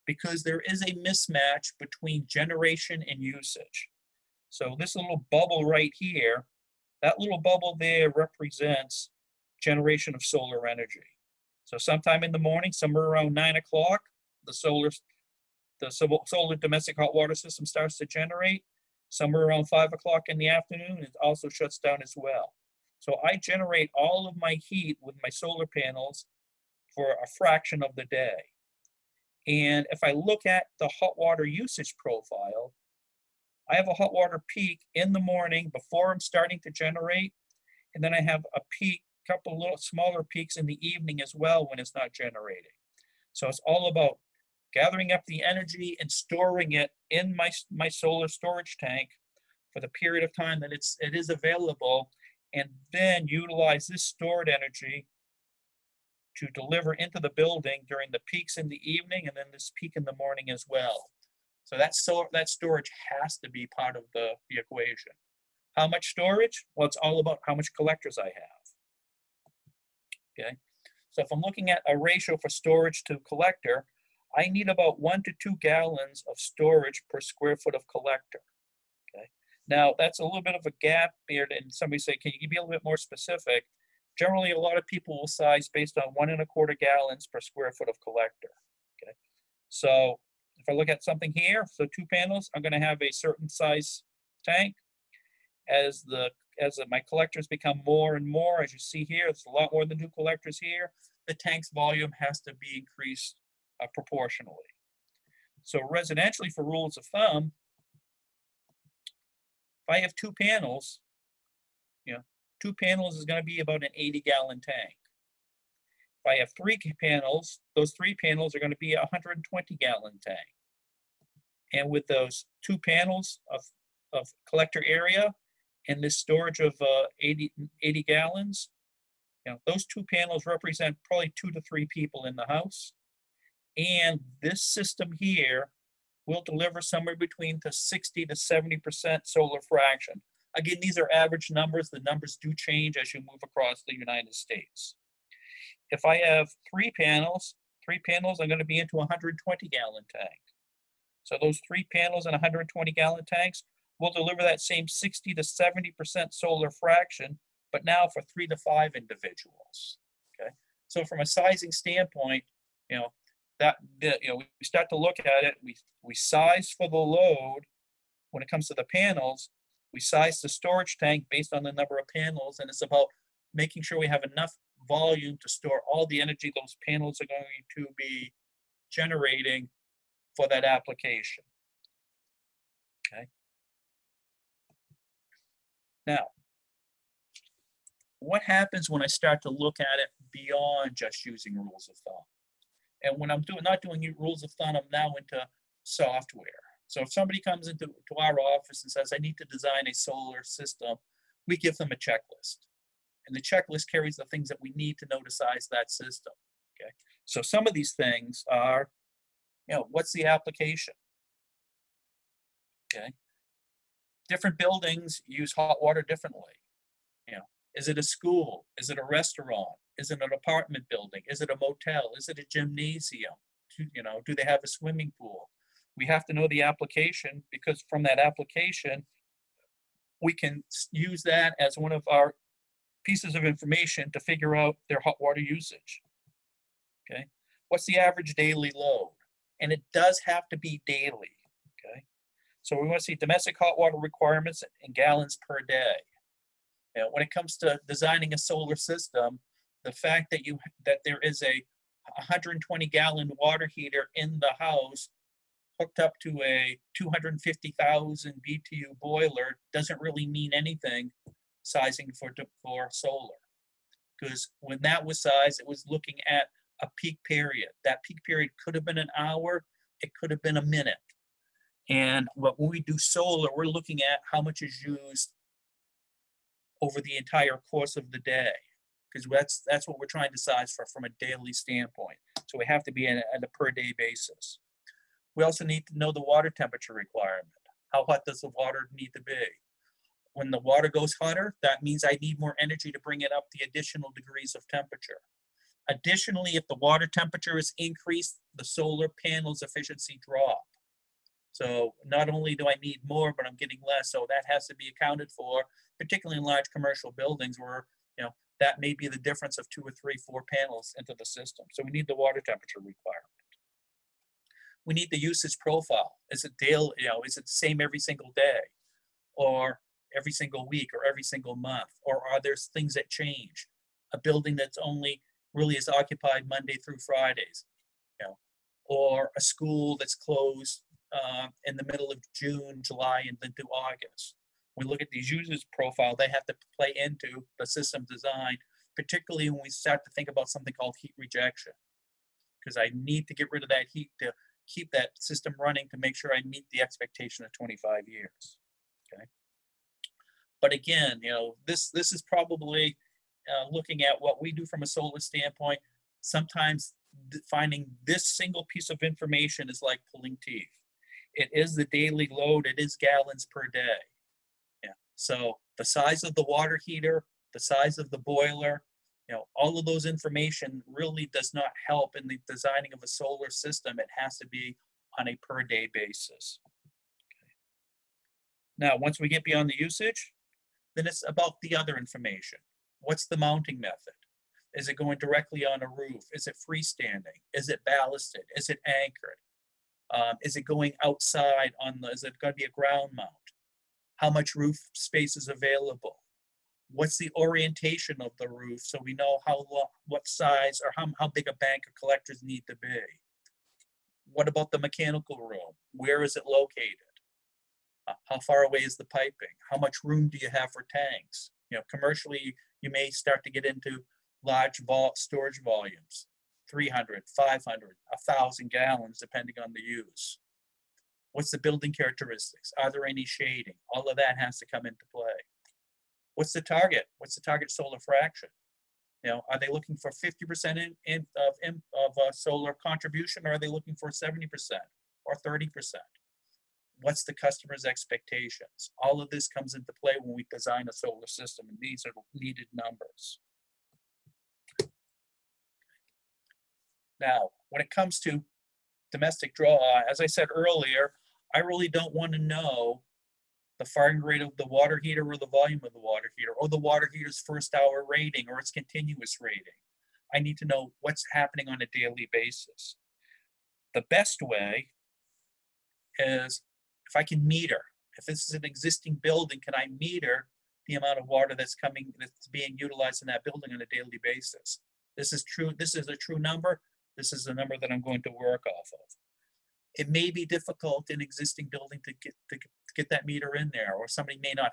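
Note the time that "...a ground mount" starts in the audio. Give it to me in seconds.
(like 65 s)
392 s.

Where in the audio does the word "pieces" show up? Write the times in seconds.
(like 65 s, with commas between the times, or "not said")
233 s, 358 s.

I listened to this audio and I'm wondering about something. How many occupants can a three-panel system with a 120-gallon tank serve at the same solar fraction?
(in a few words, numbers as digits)
3 to 5.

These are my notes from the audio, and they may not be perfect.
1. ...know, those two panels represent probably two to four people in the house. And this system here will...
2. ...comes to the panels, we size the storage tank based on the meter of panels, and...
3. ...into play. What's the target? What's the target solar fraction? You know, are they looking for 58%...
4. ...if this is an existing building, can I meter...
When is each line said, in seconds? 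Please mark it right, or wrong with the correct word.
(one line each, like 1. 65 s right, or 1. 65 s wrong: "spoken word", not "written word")
1. 129 s wrong: "three", not "four"
2. 168 s wrong: "number", not "meter"
3. 424 s wrong: "50", not "58"
4. 468 s right.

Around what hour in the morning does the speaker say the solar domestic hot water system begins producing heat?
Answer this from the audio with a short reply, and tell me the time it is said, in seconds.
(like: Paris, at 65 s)
9 o'clock, at 13 s.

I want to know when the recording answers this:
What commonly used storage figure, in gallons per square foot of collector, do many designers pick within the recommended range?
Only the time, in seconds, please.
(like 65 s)
86 s.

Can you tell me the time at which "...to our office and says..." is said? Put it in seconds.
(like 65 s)
197 s.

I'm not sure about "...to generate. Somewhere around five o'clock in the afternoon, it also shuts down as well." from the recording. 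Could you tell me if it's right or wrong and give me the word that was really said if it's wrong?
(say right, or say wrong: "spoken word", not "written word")
right.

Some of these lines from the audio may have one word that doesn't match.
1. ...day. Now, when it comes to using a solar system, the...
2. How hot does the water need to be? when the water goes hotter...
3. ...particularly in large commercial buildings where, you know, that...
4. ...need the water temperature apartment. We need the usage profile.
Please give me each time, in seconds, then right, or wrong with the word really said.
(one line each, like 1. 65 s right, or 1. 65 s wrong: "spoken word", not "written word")
1. 245 s wrong: "designing", not "using"
2. 287 s right
3. 305 s right
4. 311 s wrong: "requirement", not "apartment".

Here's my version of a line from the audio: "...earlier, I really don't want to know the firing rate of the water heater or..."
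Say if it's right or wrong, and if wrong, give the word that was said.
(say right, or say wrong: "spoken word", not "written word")
right.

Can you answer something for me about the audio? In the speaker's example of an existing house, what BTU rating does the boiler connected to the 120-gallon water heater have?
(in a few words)
250,000 BTU.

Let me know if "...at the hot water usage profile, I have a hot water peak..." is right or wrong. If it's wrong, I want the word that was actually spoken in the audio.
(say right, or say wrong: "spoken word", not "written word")
right.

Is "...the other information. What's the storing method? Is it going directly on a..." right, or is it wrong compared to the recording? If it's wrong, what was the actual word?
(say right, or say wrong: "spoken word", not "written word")
wrong: "mounting", not "storing".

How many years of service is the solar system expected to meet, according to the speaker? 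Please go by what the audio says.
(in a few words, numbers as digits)
25 years.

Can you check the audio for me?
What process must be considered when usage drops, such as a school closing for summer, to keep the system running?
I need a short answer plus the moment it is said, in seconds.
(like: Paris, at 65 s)
heat rejection, at 340 s.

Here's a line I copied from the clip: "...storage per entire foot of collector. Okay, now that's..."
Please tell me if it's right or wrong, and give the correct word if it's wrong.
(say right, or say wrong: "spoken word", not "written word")
wrong: "square", not "entire".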